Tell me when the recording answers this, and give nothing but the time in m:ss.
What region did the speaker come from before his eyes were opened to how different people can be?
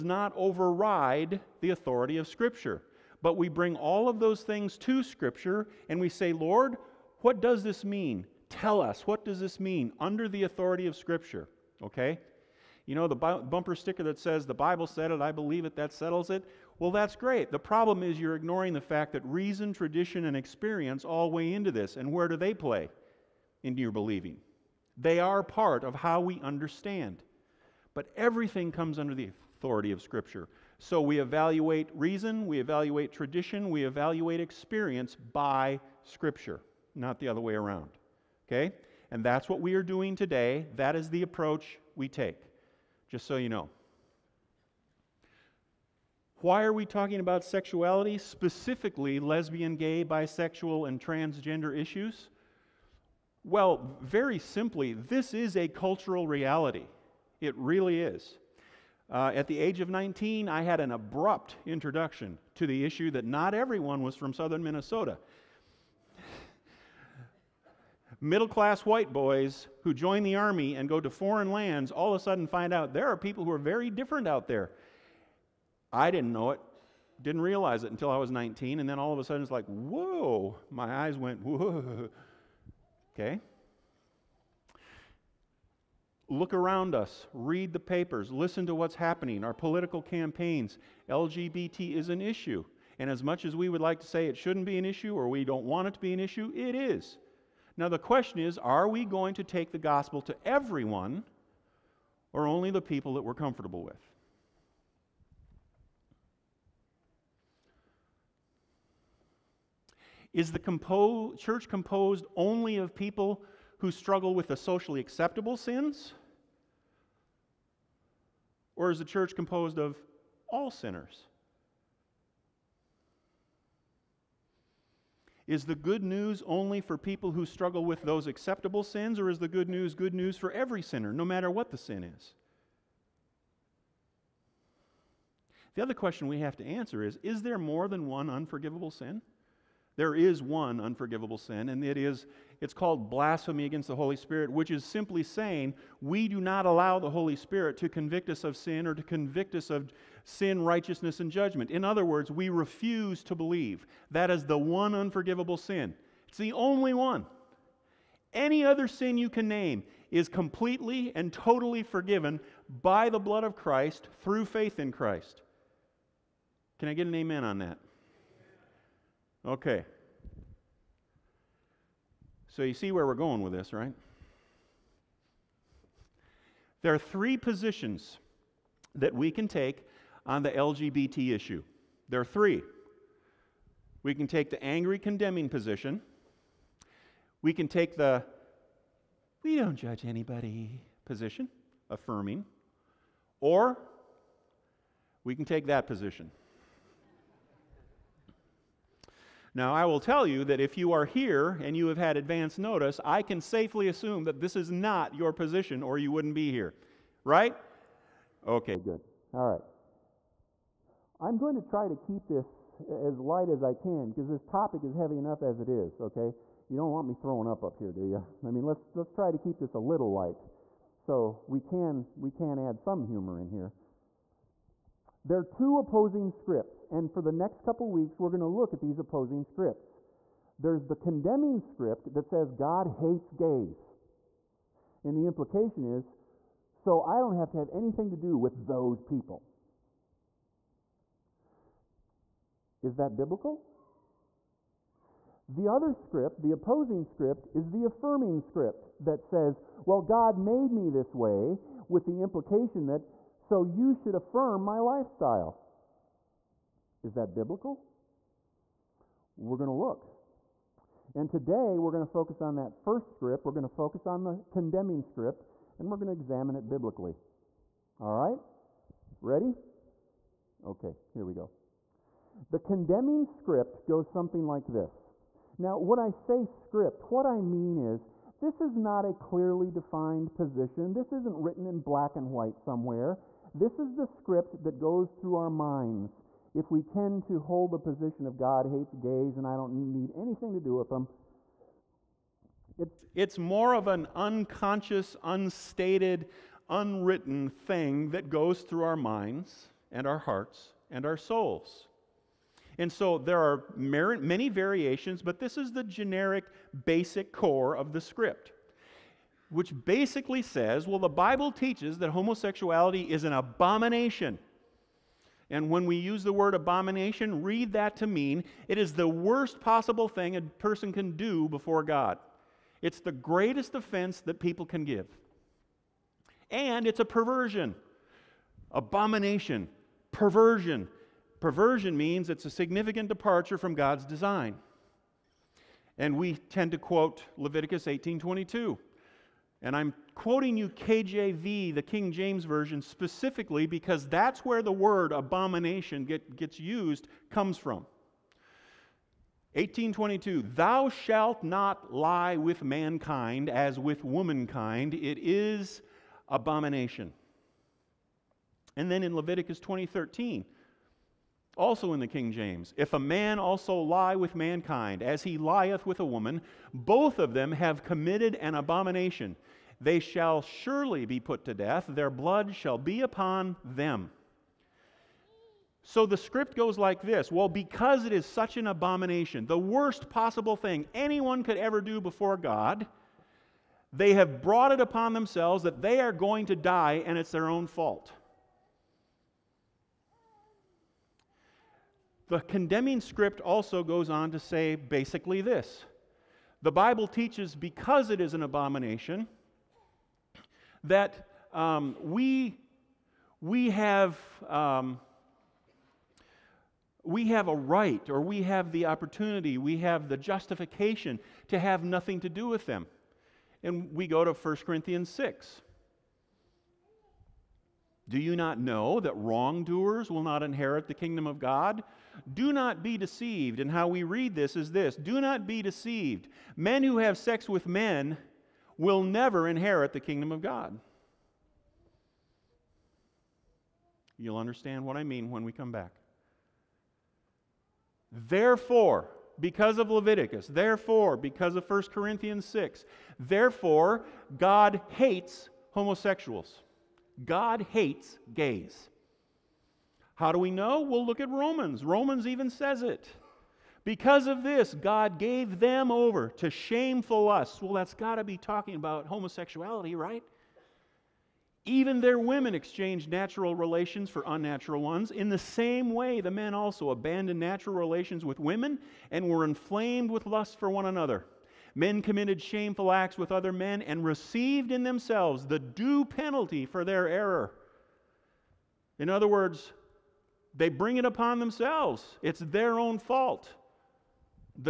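1:04.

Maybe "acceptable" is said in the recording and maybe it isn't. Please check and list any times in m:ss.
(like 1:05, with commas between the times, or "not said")
1:54, 2:08.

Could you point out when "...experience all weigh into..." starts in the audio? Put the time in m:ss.
0:20.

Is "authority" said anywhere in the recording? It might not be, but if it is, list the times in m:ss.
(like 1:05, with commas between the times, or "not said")
0:01, 0:10, 0:29.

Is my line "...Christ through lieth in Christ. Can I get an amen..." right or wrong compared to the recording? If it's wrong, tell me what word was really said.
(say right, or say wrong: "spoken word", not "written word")
wrong: "faith", not "lieth".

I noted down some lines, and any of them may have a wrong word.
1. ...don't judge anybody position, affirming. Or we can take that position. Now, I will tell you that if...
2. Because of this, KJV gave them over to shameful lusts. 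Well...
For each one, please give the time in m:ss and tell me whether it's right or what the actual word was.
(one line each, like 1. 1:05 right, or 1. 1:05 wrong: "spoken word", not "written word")
1. 3:09 right
2. 7:33 wrong: "God", not "KJV".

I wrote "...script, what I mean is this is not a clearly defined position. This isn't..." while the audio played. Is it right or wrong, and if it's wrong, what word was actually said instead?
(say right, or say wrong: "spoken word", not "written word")
right.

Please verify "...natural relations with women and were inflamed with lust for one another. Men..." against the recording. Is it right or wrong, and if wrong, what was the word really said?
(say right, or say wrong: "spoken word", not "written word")
right.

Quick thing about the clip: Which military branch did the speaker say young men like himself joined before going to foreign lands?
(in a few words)
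Army.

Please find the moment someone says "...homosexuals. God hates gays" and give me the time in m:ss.
7:25.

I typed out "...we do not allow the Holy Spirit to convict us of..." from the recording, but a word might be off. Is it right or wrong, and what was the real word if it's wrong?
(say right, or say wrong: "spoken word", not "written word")
right.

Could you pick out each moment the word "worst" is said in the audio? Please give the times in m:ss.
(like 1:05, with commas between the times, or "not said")
5:19, 6:19.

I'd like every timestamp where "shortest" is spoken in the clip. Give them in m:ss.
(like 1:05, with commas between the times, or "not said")
not said.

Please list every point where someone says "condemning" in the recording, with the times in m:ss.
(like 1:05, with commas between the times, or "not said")
3:04, 3:50, 4:24, 4:32, 6:32.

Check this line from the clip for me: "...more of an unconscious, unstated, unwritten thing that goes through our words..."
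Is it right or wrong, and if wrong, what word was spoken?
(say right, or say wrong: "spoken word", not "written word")
wrong: "minds", not "words".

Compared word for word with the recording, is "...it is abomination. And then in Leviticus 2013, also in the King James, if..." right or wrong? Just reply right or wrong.
right.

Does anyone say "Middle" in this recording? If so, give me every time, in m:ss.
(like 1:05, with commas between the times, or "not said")
1:08.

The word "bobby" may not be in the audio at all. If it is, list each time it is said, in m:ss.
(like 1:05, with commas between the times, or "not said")
not said.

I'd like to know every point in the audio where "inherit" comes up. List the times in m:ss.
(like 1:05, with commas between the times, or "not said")
7:00, 7:09.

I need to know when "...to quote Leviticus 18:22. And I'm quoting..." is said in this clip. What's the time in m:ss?
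5:36.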